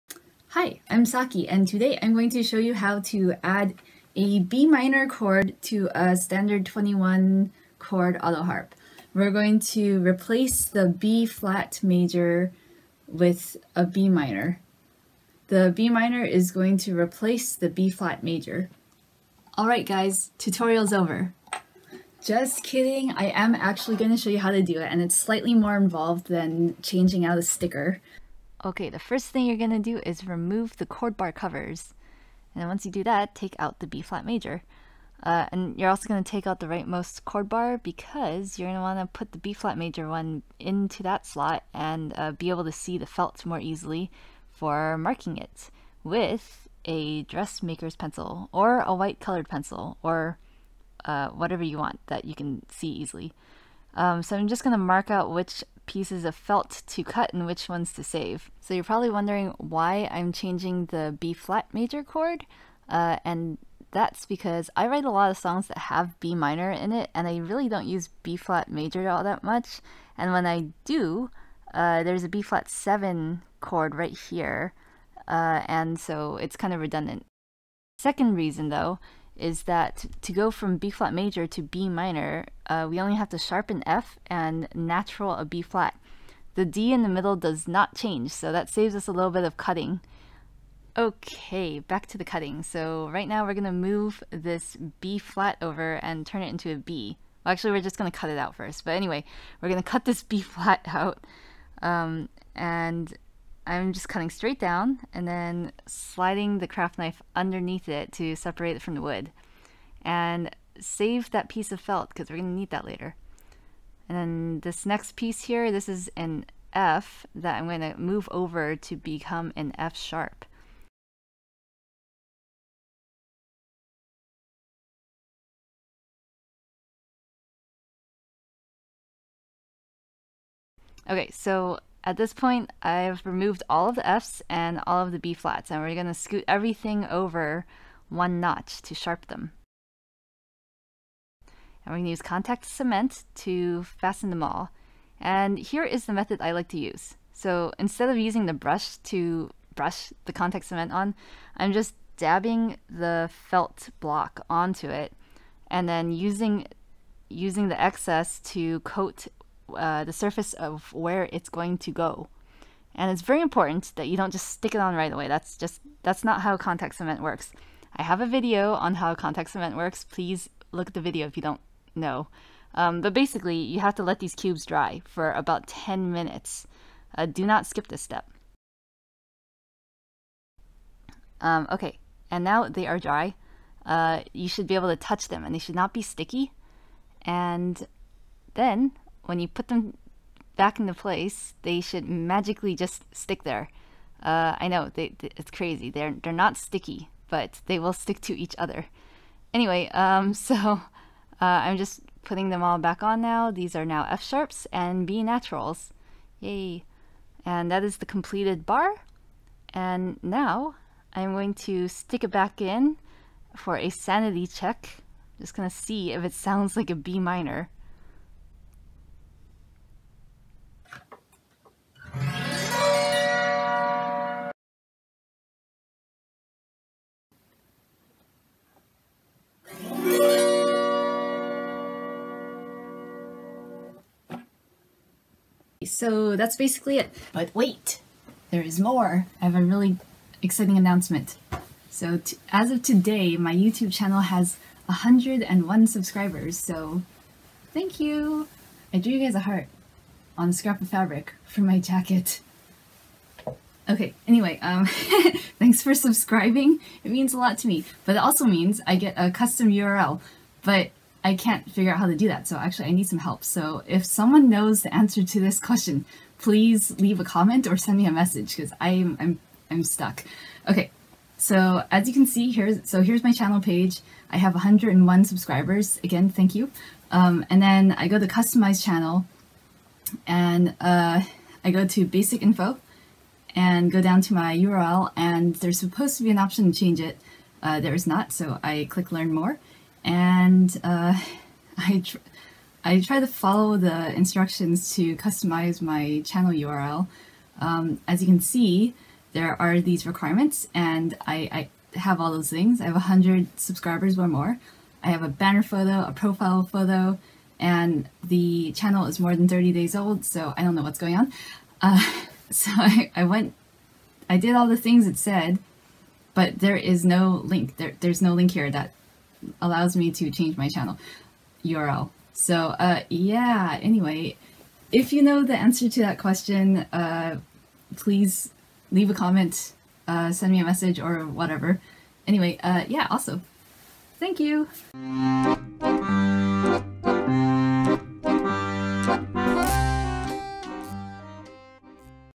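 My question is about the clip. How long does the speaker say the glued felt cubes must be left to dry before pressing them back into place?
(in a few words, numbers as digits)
10 minutes.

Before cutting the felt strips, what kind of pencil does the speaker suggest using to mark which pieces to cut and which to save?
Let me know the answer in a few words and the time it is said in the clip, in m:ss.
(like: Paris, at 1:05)
Dressmaker's pencil, at 0:47.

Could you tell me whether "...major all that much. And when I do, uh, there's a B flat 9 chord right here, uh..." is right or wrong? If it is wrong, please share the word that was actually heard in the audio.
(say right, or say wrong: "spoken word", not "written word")
wrong: "7", not "9".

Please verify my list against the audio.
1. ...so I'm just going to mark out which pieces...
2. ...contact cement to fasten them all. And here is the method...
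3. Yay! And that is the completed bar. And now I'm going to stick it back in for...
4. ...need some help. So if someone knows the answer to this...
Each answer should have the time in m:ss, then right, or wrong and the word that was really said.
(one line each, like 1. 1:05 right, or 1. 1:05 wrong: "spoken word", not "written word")
1. 0:54 right
2. 2:22 right
3. 3:26 right
4. 4:22 right.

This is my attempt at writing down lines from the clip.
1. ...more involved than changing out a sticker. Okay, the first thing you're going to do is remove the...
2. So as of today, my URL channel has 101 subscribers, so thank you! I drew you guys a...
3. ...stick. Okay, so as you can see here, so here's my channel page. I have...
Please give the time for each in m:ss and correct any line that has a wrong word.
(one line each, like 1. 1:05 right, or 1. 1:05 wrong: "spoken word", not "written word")
1. 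0:25 right
2. 4:01 wrong: "YouTube", not "URL"
3. 4:29 wrong: "stuck", not "stick".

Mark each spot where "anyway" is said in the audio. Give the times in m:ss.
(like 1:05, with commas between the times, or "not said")
1:38, 3:19, 4:14, 5:23, 5:32.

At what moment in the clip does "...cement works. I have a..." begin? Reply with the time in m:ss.
2:46.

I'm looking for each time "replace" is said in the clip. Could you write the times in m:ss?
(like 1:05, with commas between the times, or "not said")
0:10, 0:16.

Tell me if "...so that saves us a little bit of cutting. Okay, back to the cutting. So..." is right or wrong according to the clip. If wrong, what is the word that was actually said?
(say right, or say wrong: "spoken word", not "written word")
right.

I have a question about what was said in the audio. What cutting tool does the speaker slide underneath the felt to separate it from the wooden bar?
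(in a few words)
Craft knife.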